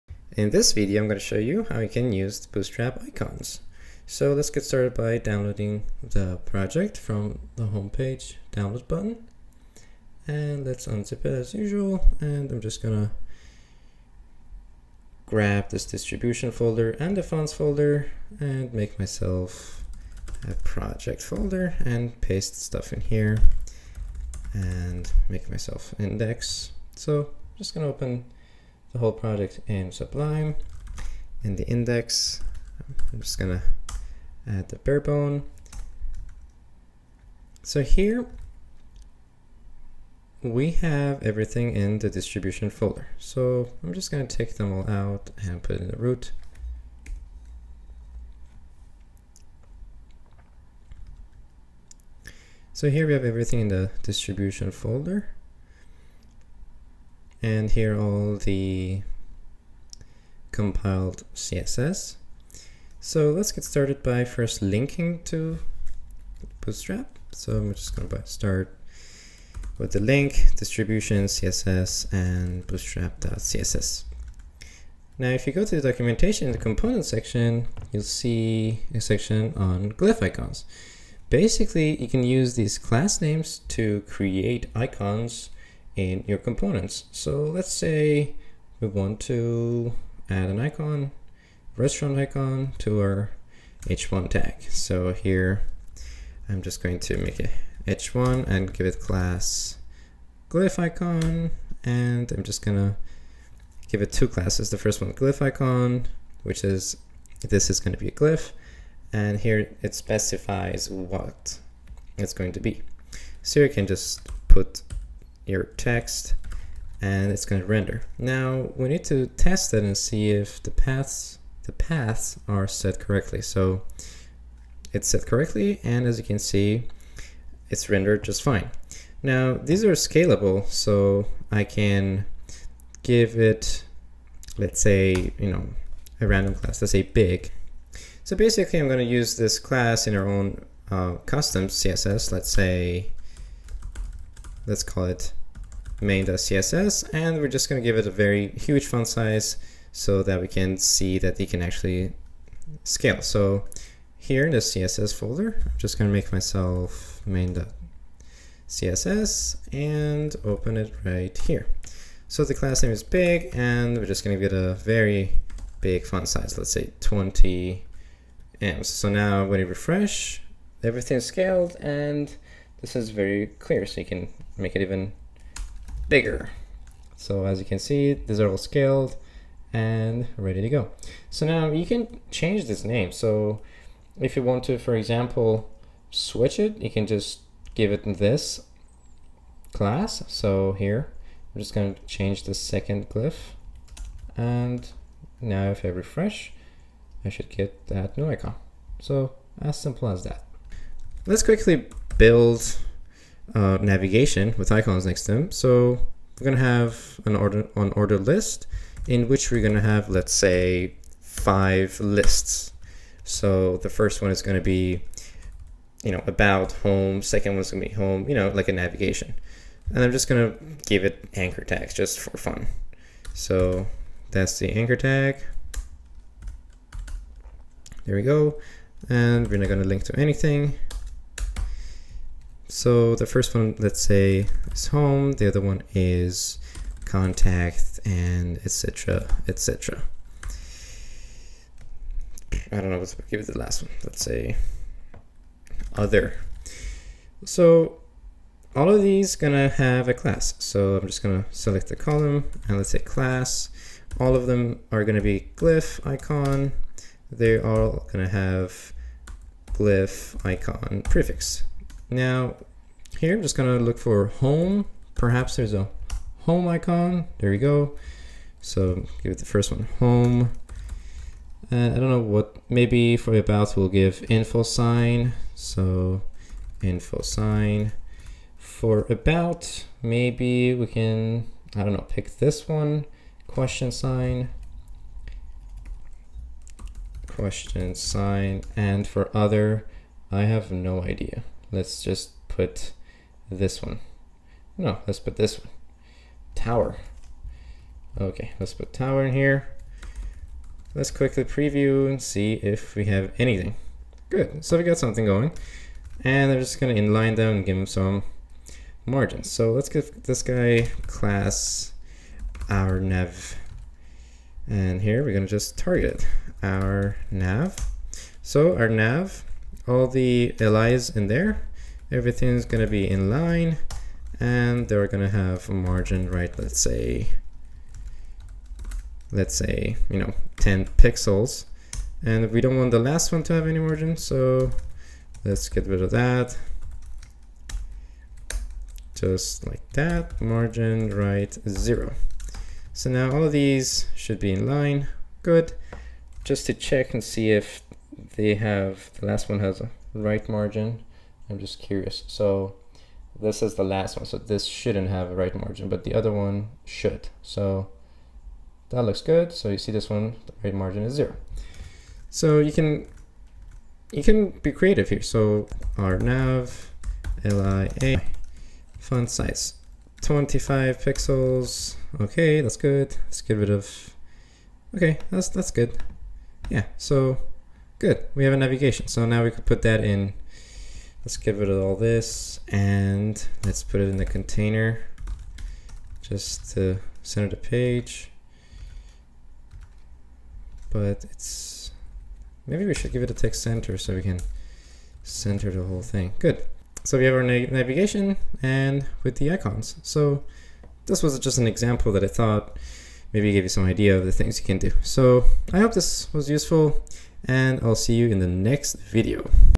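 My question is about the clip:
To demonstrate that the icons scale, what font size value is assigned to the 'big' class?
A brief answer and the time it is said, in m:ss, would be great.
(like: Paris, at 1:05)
20 ems, at 2:47.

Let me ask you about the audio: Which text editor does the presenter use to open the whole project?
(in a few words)
Sublime.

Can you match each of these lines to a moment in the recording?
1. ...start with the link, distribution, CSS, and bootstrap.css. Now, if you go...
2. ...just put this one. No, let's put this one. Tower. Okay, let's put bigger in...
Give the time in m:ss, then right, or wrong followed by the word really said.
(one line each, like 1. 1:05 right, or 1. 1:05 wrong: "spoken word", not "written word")
1. 1:08 right
2. 4:52 wrong: "tower", not "bigger".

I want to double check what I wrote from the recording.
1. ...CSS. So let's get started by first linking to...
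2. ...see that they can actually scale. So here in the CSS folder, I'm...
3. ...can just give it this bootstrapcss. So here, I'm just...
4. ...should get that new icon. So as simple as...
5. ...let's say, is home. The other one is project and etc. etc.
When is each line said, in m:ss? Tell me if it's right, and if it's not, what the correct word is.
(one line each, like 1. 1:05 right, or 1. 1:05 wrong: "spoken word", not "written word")
1. 1:01 right
2. 2:30 right
3. 3:06 wrong: "class", not "bootstrapcss"
4. 3:17 right
5. 3:53 wrong: "contact", not "project".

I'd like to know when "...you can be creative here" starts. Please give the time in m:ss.
6:04.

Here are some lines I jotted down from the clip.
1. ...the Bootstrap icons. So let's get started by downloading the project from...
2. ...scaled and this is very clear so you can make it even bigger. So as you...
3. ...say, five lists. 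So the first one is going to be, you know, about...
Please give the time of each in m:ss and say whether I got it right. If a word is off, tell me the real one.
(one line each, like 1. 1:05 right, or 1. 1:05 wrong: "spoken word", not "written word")
1. 0:02 right
2. 2:51 right
3. 3:30 right.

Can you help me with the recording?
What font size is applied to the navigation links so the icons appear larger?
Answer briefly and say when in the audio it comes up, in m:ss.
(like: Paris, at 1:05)
25 pixels, at 6:10.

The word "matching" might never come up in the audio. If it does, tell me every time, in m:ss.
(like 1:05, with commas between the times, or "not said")
not said.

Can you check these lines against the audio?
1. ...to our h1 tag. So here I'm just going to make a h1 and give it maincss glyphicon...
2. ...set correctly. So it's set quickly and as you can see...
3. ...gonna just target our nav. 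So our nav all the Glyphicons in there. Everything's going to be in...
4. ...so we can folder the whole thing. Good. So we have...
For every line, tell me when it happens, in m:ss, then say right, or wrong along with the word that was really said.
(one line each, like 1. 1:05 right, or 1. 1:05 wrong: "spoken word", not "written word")
1. 1:32 wrong: "class", not "maincss"
2. 2:02 wrong: "correctly", not "quickly"
3. 5:15 wrong: "LIs", not "Glyphicons"
4. 6:33 wrong: "center", not "folder".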